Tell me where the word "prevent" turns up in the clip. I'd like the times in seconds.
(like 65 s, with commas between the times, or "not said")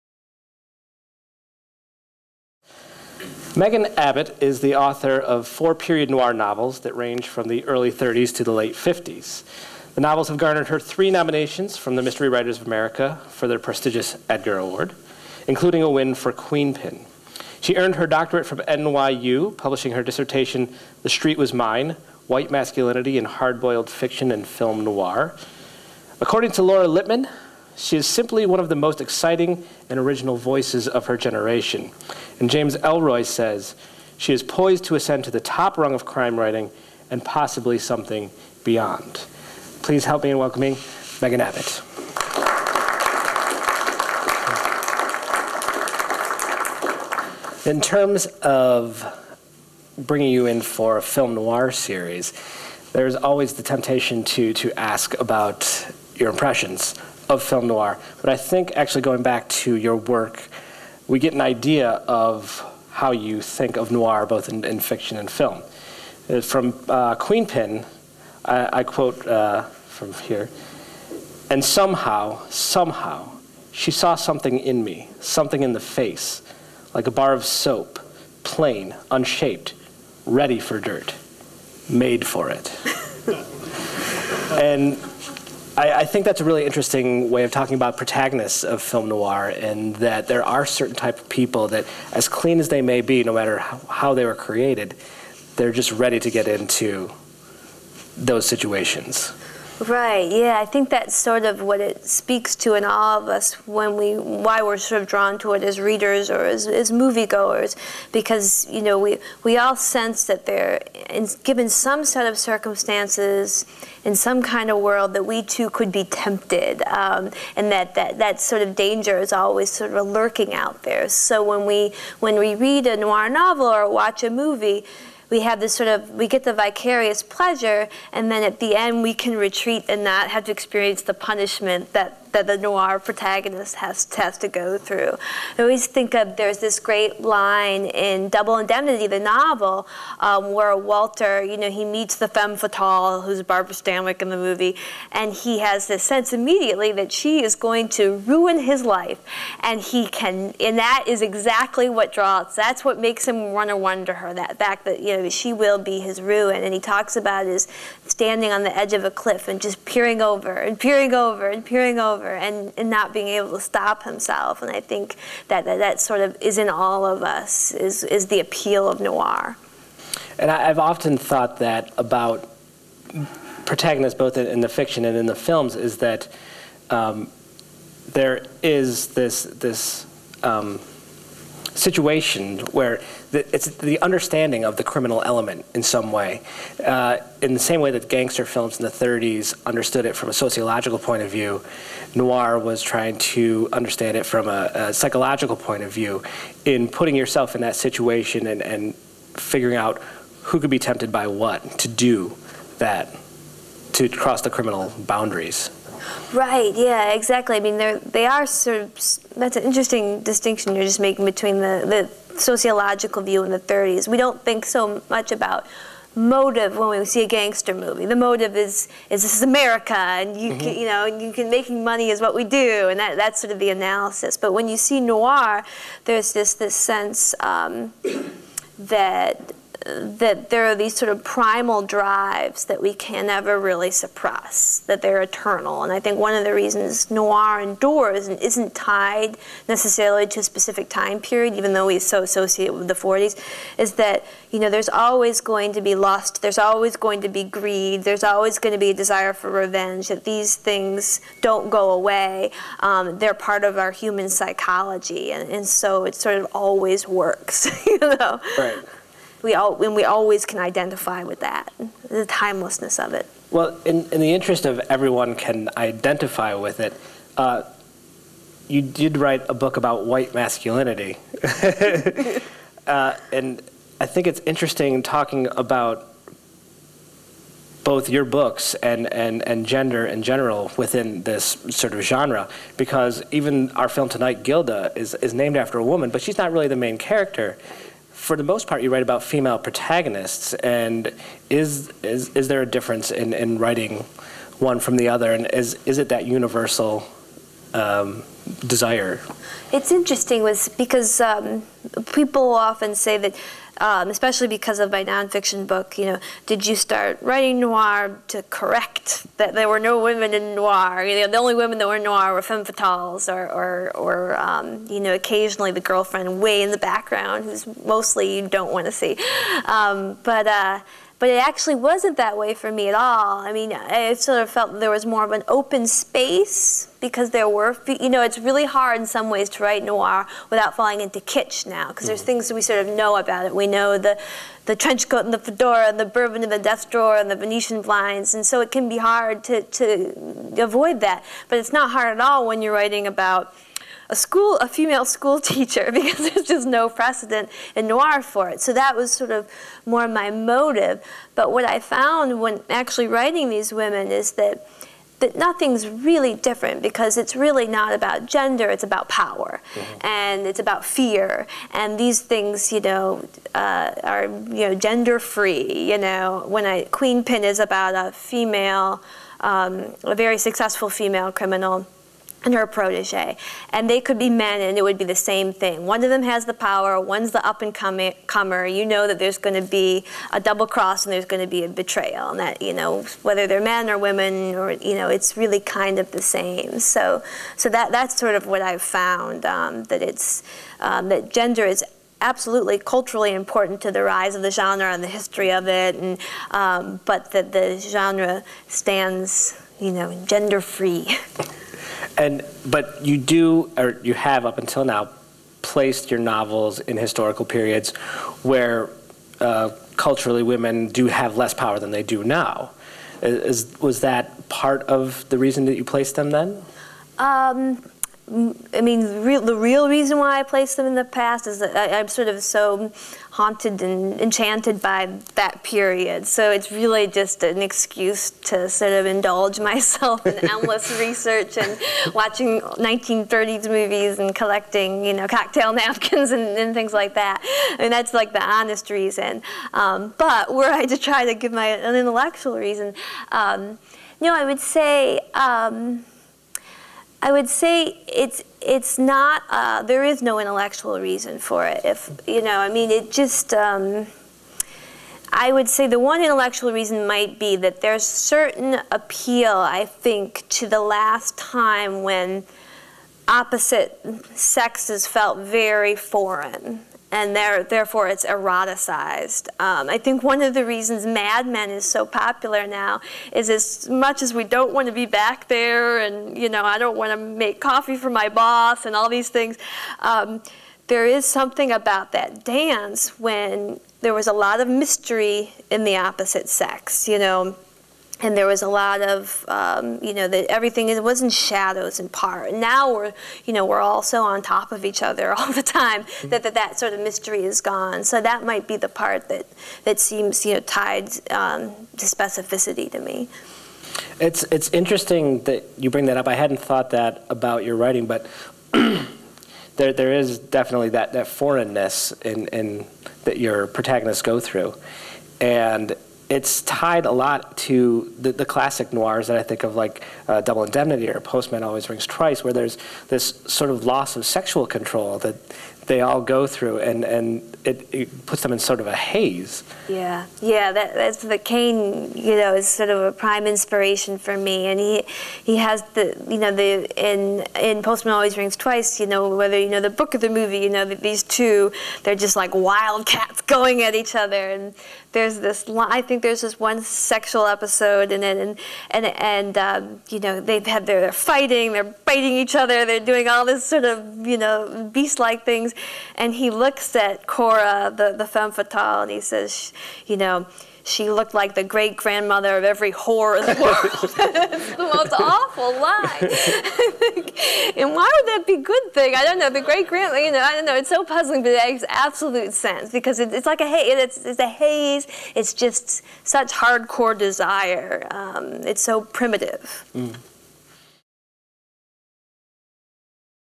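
not said.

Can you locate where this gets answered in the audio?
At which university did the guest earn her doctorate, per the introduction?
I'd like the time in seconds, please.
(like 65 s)
18 s.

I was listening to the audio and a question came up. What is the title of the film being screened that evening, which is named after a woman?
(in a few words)
Gilda.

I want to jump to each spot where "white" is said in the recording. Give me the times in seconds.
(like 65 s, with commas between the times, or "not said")
22 s, 270 s.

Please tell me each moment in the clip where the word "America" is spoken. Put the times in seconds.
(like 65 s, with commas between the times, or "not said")
12 s, 219 s.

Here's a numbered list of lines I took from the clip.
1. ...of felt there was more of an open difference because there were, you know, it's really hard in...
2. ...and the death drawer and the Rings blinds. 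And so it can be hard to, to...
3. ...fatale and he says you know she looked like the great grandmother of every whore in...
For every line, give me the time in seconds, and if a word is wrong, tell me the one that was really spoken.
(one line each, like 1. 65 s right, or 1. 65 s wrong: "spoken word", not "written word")
1. 324 s wrong: "space", not "difference"
2. 336 s wrong: "Venetian", not "Rings"
3. 558 s right.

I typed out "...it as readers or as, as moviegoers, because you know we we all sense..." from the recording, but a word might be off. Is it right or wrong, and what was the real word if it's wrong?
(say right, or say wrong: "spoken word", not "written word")
right.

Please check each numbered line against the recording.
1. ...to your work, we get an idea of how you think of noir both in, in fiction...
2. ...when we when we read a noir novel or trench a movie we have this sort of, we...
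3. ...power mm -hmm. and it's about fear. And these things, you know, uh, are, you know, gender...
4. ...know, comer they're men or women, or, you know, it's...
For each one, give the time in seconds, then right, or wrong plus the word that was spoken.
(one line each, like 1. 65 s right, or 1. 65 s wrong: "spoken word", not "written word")
1. 59 s right
2. 121 s wrong: "watch", not "trench"
3. 359 s right
4. 382 s wrong: "whether", not "comer".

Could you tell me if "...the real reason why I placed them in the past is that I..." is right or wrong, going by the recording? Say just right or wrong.
right.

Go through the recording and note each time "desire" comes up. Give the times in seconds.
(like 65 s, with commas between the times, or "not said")
248 s, 298 s, 577 s.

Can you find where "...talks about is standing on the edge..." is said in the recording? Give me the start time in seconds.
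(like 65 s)
156 s.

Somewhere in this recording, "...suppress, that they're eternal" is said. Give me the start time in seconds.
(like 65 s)
233 s.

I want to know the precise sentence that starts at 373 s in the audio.
And they could be men, and it would be the same thing.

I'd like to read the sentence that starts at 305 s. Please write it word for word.
You know, did you start writing noir to correct that there were no women in noir?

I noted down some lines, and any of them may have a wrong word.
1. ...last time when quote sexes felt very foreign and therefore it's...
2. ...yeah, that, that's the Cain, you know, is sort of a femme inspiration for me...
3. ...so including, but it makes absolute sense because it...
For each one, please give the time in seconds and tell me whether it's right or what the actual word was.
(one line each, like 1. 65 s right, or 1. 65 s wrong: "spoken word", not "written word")
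1. 460 s wrong: "opposite", not "quote"
2. 530 s wrong: "prime", not "femme"
3. 570 s wrong: "puzzling", not "including".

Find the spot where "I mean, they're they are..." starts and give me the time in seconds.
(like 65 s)
207 s.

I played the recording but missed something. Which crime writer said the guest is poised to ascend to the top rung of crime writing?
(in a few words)
James Ellroy.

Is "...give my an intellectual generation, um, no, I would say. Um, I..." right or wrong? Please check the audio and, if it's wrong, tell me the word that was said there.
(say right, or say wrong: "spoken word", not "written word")
wrong: "reason", not "generation".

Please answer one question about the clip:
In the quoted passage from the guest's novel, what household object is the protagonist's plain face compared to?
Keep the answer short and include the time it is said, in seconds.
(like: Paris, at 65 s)
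a bar of soap, at 77 s.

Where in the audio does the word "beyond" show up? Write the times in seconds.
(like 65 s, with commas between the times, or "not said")
38 s.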